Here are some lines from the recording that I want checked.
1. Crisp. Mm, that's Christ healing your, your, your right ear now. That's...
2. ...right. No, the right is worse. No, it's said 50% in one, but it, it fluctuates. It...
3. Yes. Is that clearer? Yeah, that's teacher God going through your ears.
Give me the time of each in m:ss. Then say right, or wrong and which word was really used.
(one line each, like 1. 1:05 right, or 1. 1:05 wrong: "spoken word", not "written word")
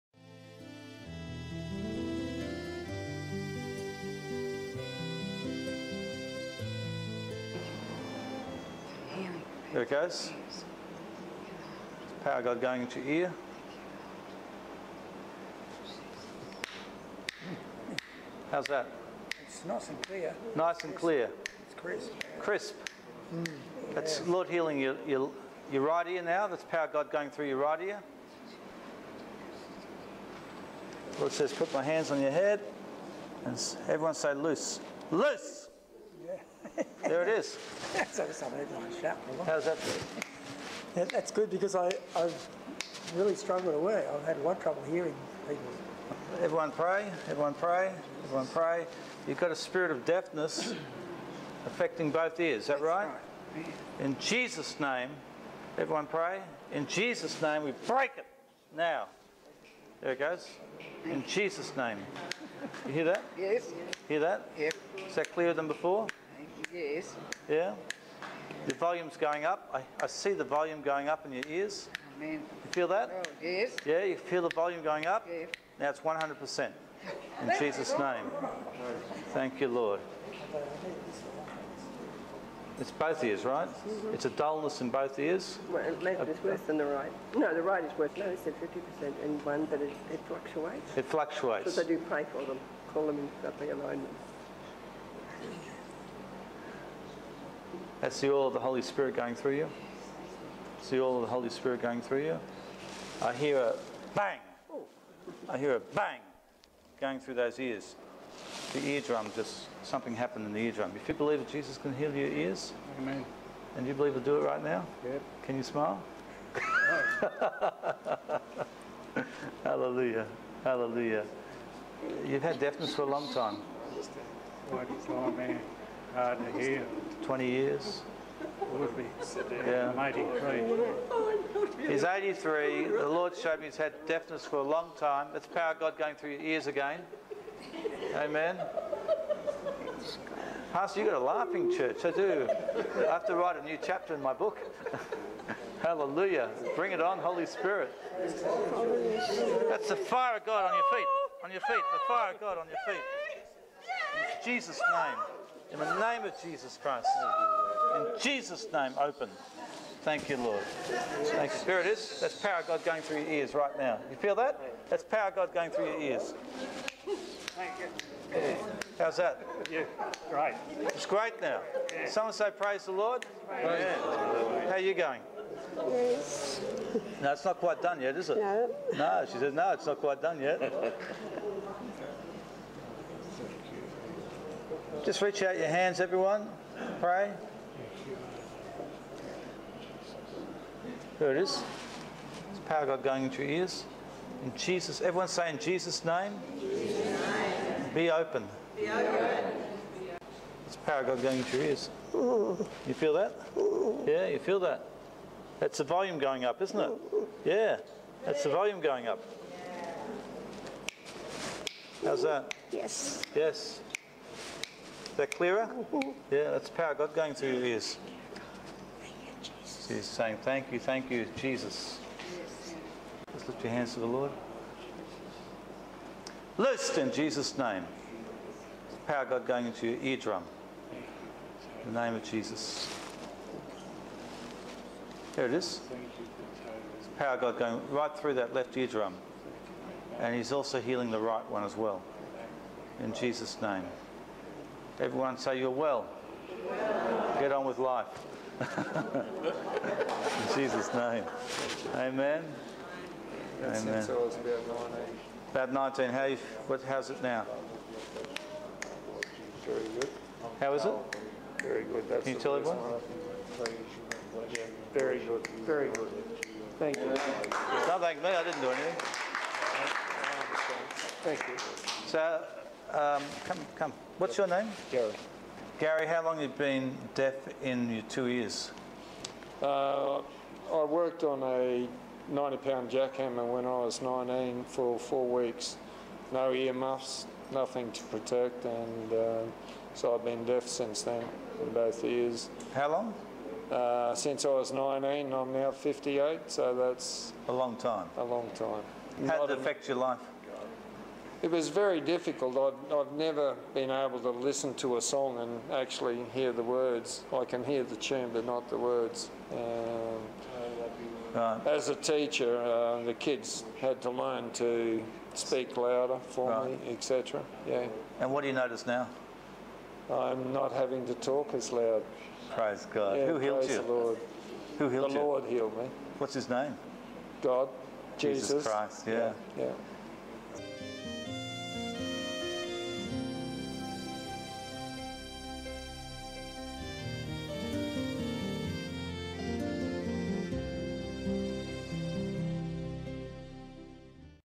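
1. 0:22 wrong: "Lord", not "Christ"
2. 1:26 right
3. 3:33 wrong: "power", not "teacher".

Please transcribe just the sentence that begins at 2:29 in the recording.
That's the fire of God on your feet.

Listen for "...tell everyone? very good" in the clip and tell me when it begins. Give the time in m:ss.
4:22.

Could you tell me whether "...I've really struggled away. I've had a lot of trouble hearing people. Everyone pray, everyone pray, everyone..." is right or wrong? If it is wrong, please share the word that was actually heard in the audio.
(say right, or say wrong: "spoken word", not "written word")
right.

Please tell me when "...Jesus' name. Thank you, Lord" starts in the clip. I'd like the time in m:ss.
1:17.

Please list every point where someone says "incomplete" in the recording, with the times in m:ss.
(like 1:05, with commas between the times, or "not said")
not said.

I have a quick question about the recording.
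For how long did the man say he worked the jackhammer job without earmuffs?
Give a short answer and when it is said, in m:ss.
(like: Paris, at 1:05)
4 weeks, at 4:44.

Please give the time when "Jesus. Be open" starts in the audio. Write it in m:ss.
3:16.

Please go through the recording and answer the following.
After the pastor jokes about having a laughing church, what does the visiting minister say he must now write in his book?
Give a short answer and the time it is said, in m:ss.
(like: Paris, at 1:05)
A new chapter, at 2:23.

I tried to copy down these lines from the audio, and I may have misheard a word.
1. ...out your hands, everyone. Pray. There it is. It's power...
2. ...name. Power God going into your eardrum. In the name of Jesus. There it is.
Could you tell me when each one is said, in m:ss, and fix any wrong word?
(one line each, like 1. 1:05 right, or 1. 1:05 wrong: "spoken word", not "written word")
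1. 3:05 right
2. 3:47 right.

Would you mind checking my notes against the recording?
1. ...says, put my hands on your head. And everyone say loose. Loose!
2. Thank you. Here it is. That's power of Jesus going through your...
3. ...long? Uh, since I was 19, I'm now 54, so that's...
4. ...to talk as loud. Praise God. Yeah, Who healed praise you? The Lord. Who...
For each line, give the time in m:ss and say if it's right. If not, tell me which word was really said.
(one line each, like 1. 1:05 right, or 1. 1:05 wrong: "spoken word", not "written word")
1. 0:31 right
2. 2:40 wrong: "God", not "Jesus"
3. 4:52 wrong: "58", not "54"
4. 5:21 right.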